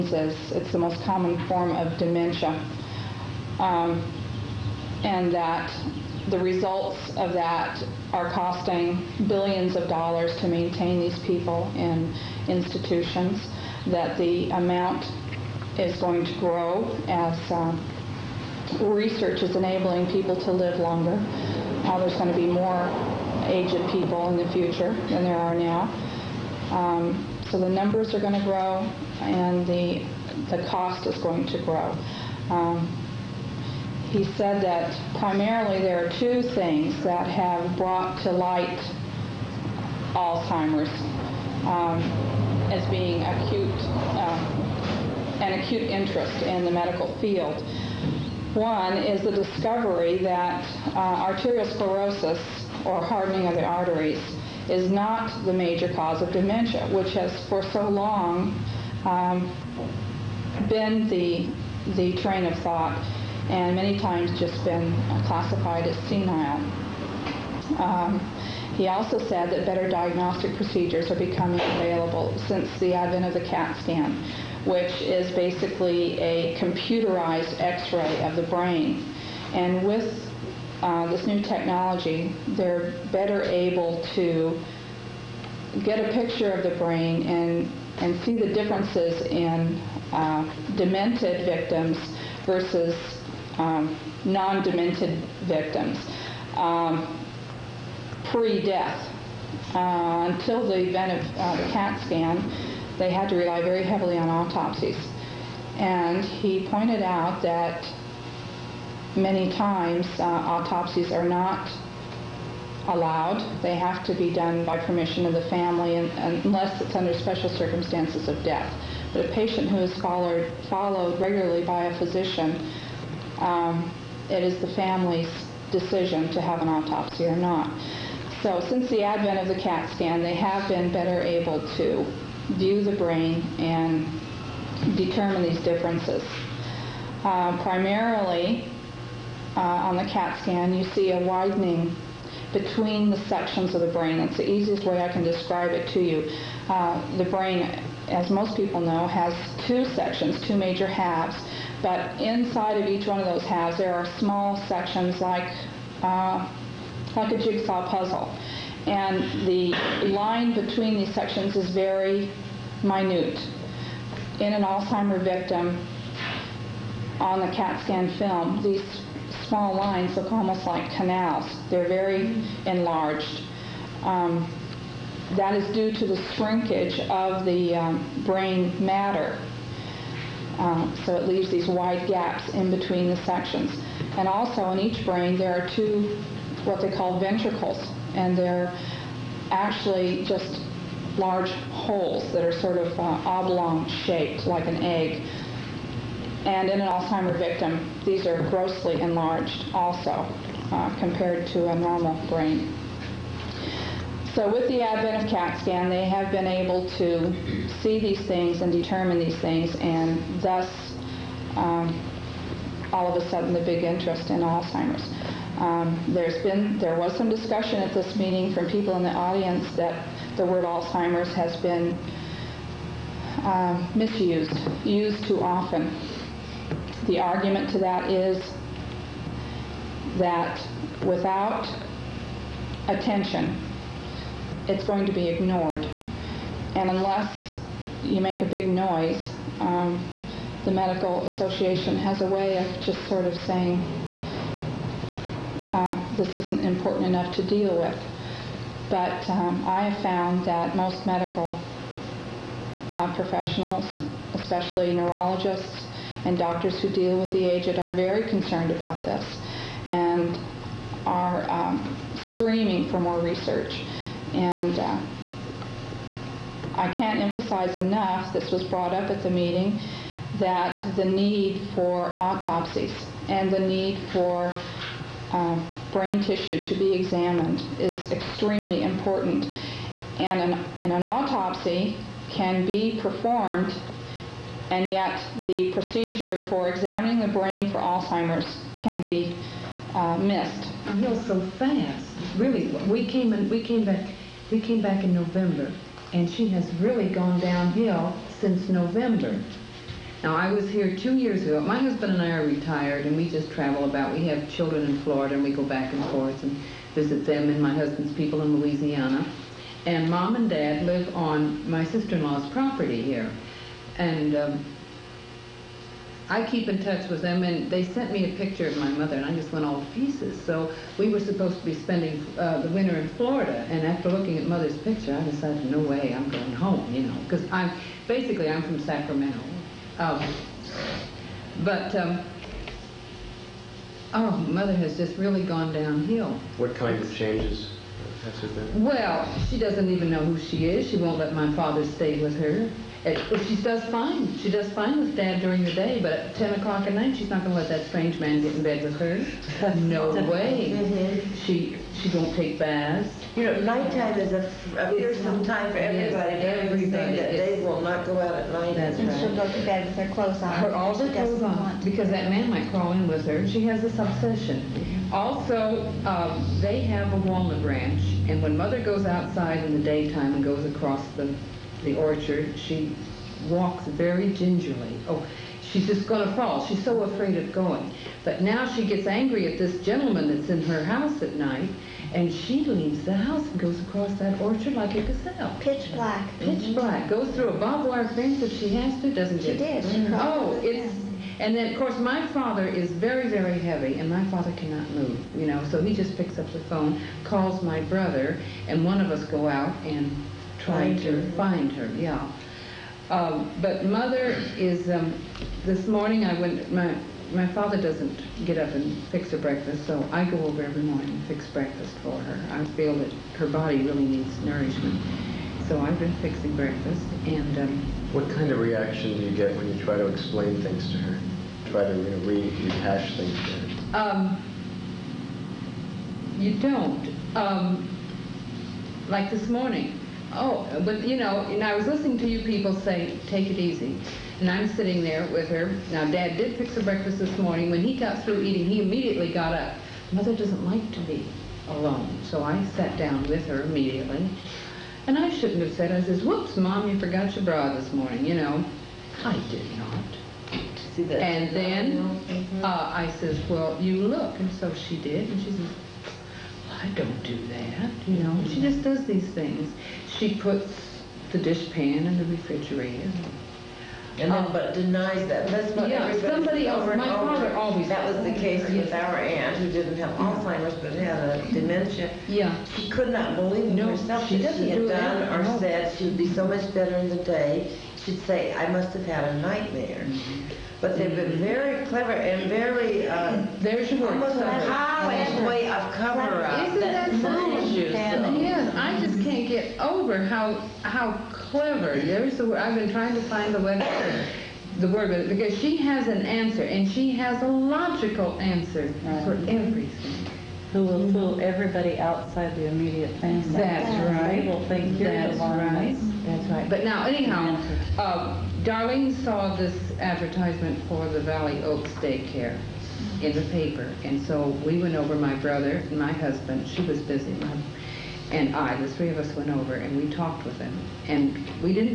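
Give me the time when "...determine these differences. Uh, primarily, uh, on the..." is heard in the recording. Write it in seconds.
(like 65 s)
134 s.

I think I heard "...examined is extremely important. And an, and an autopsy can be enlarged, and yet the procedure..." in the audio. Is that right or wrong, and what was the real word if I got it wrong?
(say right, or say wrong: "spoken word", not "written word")
wrong: "performed", not "enlarged".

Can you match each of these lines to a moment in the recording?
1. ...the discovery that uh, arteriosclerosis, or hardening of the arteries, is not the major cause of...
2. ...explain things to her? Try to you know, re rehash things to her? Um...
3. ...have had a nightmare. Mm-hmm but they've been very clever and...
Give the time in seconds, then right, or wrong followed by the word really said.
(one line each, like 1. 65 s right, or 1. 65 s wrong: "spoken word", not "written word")
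1. 49 s right
2. 420 s right
3. 478 s right.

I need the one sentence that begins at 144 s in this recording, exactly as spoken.
That's the easiest way I can describe it to you.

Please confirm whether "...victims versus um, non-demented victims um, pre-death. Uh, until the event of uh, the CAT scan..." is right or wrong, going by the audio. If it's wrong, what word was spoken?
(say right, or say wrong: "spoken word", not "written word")
right.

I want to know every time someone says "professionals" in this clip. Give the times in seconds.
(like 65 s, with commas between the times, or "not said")
253 s.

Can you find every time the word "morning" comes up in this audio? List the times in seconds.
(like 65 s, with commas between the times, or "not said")
405 s, 410 s, 429 s, 437 s, 447 s.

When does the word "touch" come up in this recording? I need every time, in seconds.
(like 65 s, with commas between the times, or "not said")
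316 s.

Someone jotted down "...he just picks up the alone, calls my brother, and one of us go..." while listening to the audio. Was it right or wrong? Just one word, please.
wrong.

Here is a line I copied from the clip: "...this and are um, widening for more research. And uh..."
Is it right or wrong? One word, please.
wrong.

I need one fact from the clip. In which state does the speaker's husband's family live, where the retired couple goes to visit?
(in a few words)
Louisiana.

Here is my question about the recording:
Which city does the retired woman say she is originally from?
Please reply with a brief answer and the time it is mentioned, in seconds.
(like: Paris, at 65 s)
Sacramento, at 328 s.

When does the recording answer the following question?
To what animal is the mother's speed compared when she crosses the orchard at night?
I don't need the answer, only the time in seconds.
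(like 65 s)
385 s.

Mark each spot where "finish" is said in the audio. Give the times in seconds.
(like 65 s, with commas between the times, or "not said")
not said.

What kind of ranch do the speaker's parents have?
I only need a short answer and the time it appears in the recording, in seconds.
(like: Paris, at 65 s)
walnut ranch, at 367 s.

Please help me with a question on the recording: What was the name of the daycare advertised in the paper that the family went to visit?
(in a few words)
Valley Oaks.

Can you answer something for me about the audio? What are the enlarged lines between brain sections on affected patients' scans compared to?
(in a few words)
canals.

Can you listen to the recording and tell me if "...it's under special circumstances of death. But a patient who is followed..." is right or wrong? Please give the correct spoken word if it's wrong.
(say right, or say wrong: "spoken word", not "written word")
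right.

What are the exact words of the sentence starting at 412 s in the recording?
I feel that her body really needs nourishment.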